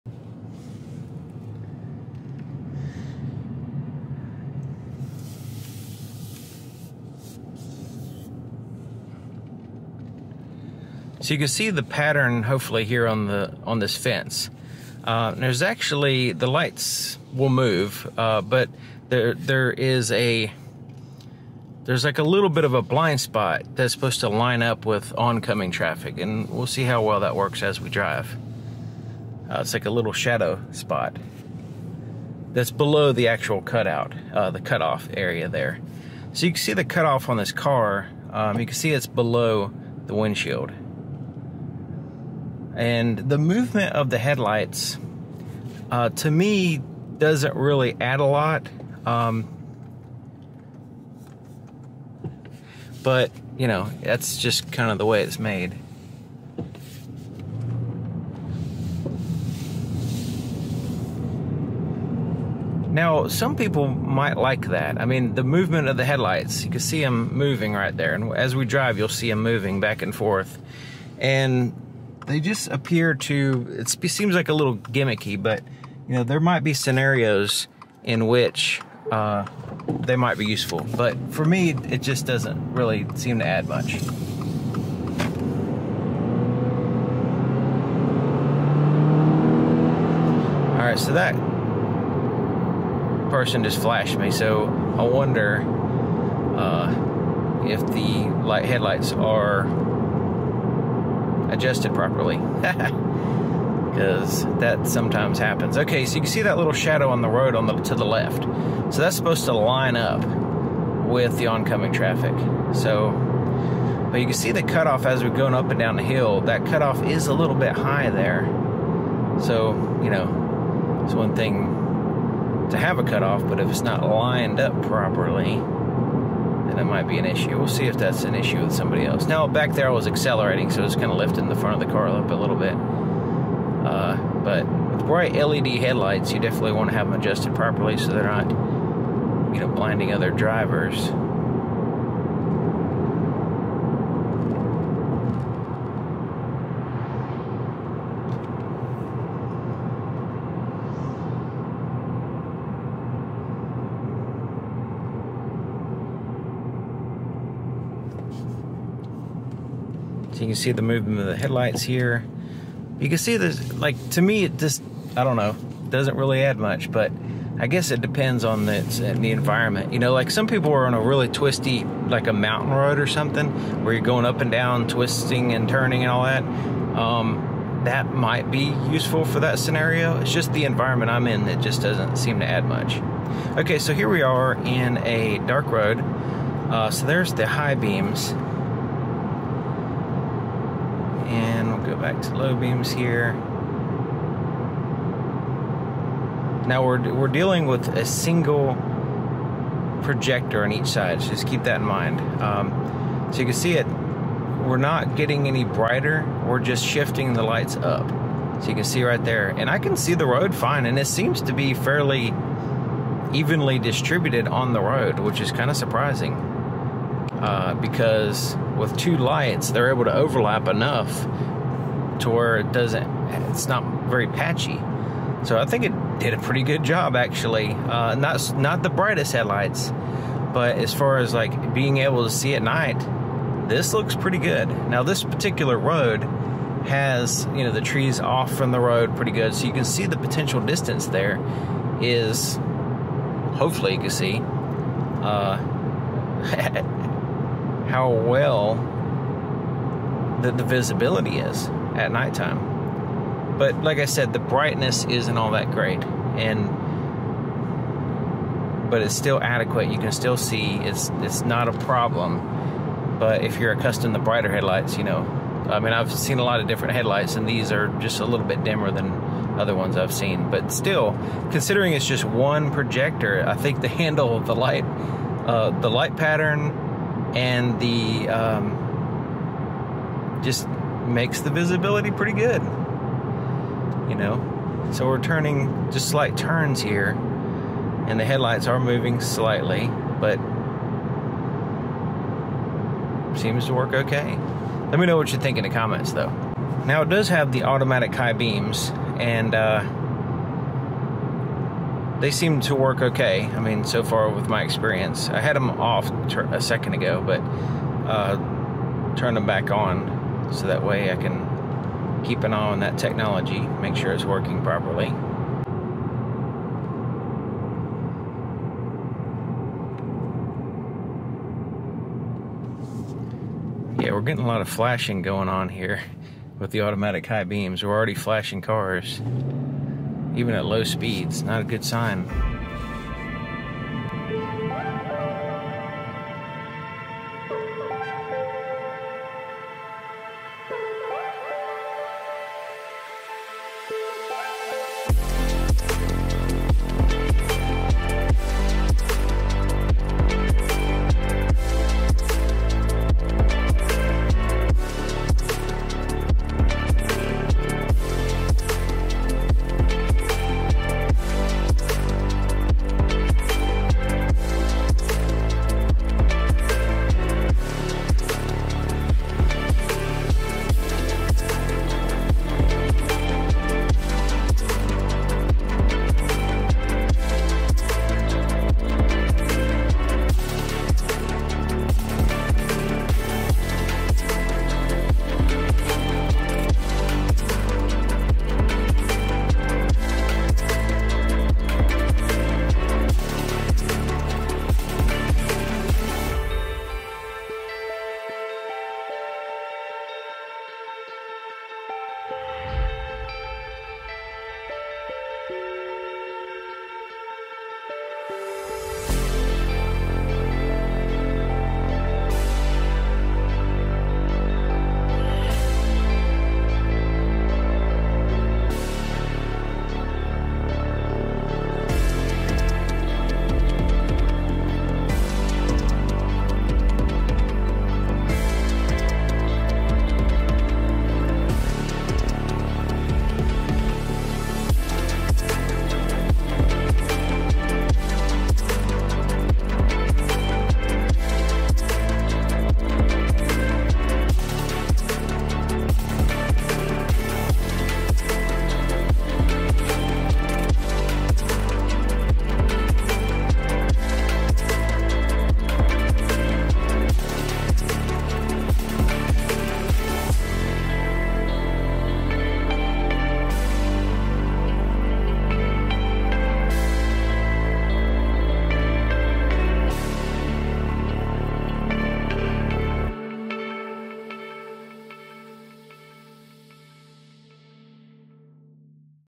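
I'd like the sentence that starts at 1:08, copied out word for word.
And as we drive, you'll see them moving back and forth.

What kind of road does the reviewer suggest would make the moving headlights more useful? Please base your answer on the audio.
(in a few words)
A mountain road.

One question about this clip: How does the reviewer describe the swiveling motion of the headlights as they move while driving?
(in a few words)
Gimmicky.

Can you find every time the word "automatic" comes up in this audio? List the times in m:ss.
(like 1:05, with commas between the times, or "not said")
4:57, 5:26.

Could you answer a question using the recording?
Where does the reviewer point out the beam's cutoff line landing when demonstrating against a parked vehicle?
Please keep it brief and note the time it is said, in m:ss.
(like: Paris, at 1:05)
Below the windshield, at 0:39.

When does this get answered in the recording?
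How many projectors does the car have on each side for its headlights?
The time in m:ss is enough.
3:17.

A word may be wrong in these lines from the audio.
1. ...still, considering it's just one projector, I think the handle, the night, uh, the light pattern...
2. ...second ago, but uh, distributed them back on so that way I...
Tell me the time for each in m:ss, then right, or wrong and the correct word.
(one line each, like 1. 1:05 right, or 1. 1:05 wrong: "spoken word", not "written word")
1. 4:30 wrong: "light", not "night"
2. 5:06 wrong: "turned", not "distributed".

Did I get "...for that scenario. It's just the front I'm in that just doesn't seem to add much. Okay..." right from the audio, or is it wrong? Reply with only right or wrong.
wrong.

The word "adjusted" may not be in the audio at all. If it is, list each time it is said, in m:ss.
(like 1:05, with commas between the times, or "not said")
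1:41, 2:17.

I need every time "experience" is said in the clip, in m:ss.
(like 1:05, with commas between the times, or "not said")
5:04.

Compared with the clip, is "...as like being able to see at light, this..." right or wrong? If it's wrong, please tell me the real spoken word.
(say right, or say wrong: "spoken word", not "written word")
wrong: "night", not "light".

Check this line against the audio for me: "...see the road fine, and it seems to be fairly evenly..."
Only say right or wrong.
right.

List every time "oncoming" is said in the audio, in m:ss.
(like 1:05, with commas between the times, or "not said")
0:25, 1:51.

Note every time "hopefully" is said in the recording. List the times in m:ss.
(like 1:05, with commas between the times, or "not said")
0:12, 4:03.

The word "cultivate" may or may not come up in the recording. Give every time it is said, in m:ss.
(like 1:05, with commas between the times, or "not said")
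not said.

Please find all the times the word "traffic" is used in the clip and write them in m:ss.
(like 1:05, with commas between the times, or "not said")
0:25, 1:51.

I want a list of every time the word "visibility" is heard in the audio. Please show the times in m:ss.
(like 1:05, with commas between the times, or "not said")
4:10, 4:41.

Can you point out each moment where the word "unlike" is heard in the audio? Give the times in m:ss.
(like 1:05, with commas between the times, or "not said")
not said.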